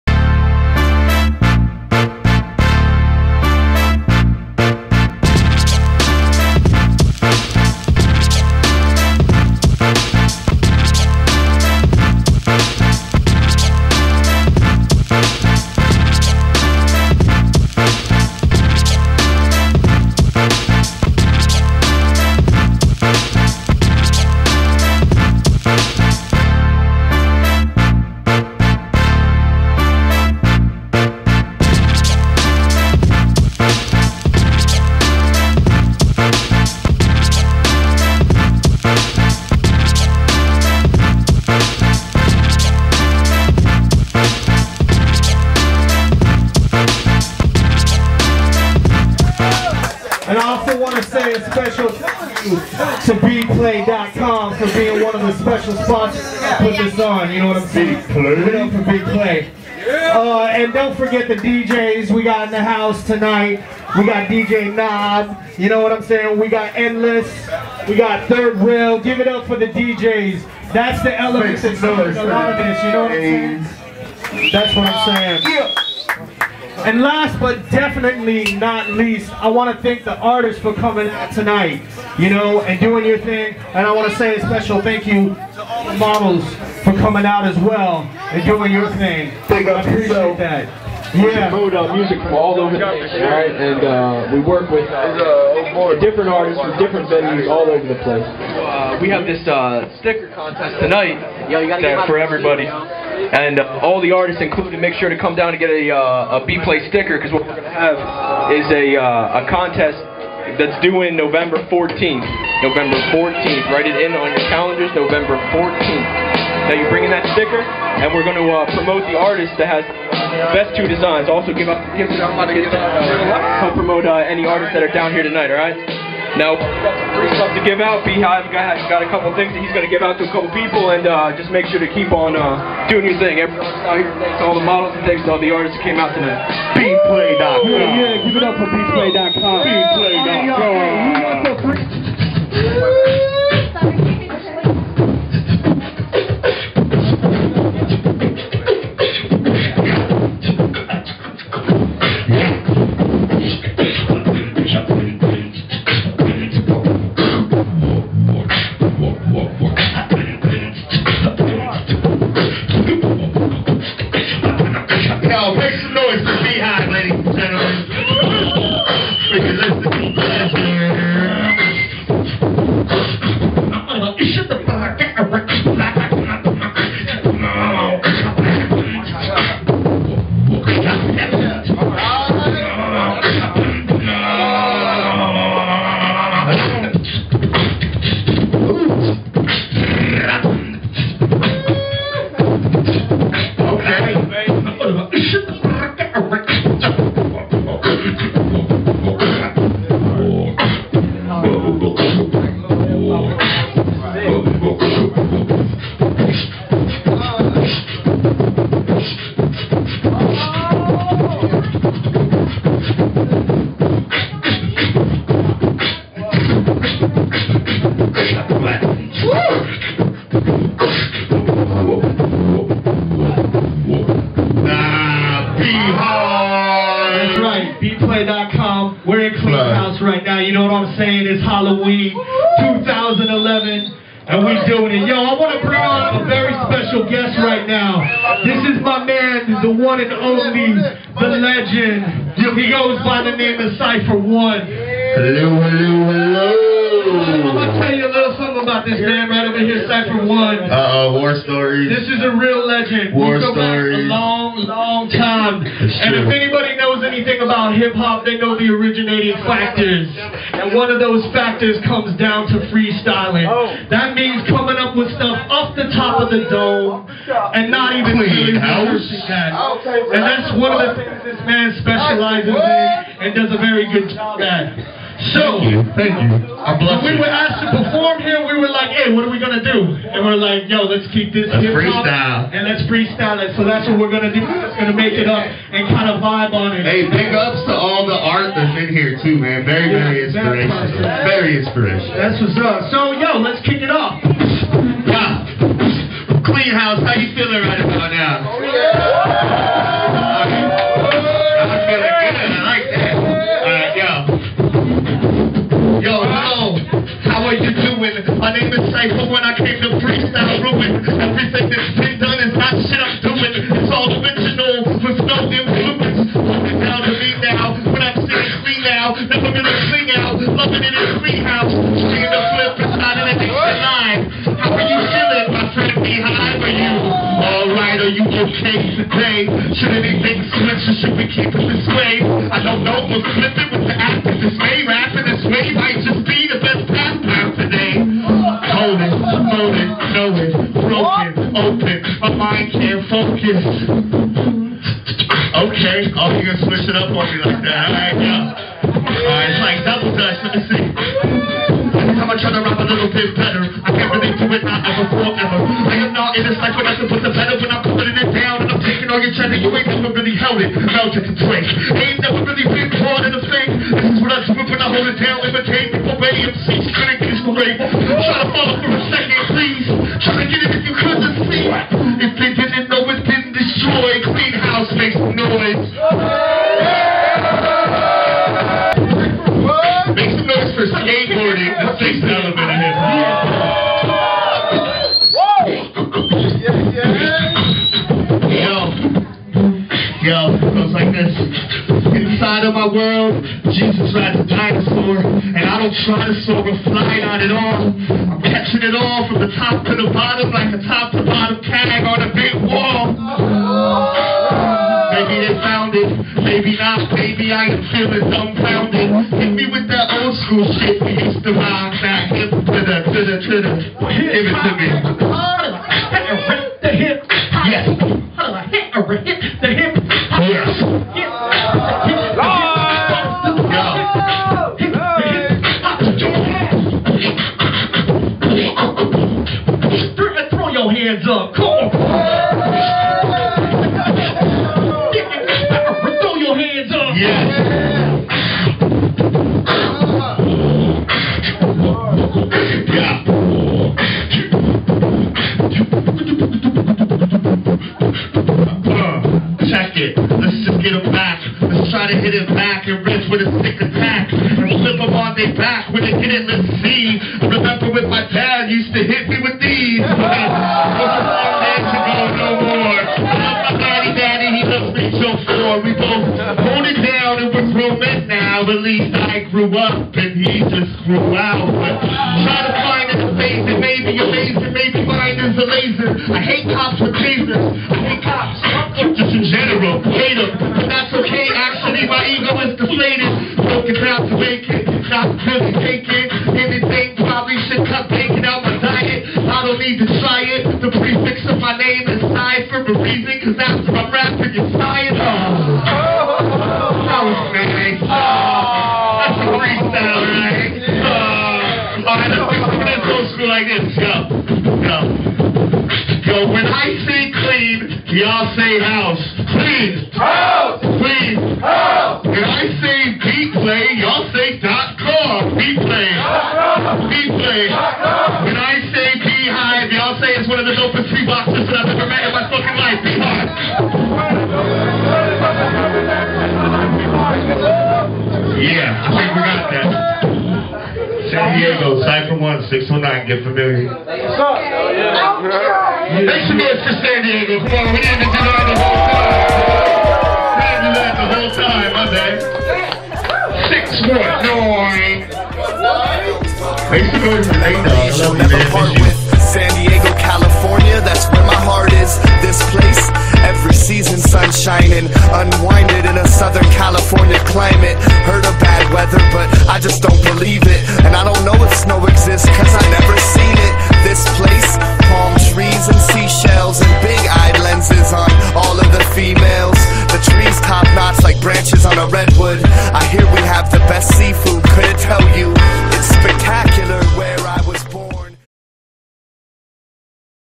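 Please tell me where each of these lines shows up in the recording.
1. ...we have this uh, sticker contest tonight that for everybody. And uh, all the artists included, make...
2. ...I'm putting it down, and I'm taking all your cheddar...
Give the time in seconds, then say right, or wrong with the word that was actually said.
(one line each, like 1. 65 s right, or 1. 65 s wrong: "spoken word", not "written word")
1. 99 s right
2. 357 s right.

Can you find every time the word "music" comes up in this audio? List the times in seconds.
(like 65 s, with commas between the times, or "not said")
91 s.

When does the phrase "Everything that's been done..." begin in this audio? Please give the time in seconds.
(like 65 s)
311 s.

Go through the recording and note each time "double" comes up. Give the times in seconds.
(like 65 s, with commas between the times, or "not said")
349 s.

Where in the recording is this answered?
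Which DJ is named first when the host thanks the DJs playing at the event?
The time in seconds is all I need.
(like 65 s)
64 s.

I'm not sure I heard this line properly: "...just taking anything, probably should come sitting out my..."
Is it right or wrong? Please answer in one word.
wrong.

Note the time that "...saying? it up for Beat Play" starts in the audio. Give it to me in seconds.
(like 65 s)
57 s.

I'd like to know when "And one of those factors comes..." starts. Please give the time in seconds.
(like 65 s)
260 s.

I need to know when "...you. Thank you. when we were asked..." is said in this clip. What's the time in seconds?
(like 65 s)
275 s.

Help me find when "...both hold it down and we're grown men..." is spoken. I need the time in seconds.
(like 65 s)
465 s.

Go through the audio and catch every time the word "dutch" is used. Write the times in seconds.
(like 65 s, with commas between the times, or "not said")
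350 s.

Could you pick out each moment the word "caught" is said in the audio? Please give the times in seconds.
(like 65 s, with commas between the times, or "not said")
362 s.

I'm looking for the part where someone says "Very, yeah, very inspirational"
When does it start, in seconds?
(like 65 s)
289 s.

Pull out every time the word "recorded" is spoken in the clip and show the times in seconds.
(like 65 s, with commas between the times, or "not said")
not said.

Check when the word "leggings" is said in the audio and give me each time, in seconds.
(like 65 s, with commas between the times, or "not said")
not said.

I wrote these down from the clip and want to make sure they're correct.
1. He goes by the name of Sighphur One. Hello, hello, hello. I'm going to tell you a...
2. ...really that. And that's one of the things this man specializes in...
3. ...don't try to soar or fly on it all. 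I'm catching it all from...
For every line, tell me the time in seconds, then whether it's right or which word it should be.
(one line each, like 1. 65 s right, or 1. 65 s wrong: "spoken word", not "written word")
1. 242 s right
2. 268 s right
3. 395 s right.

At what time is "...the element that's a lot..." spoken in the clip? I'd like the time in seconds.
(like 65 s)
71 s.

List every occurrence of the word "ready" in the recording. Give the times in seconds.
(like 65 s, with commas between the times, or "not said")
366 s.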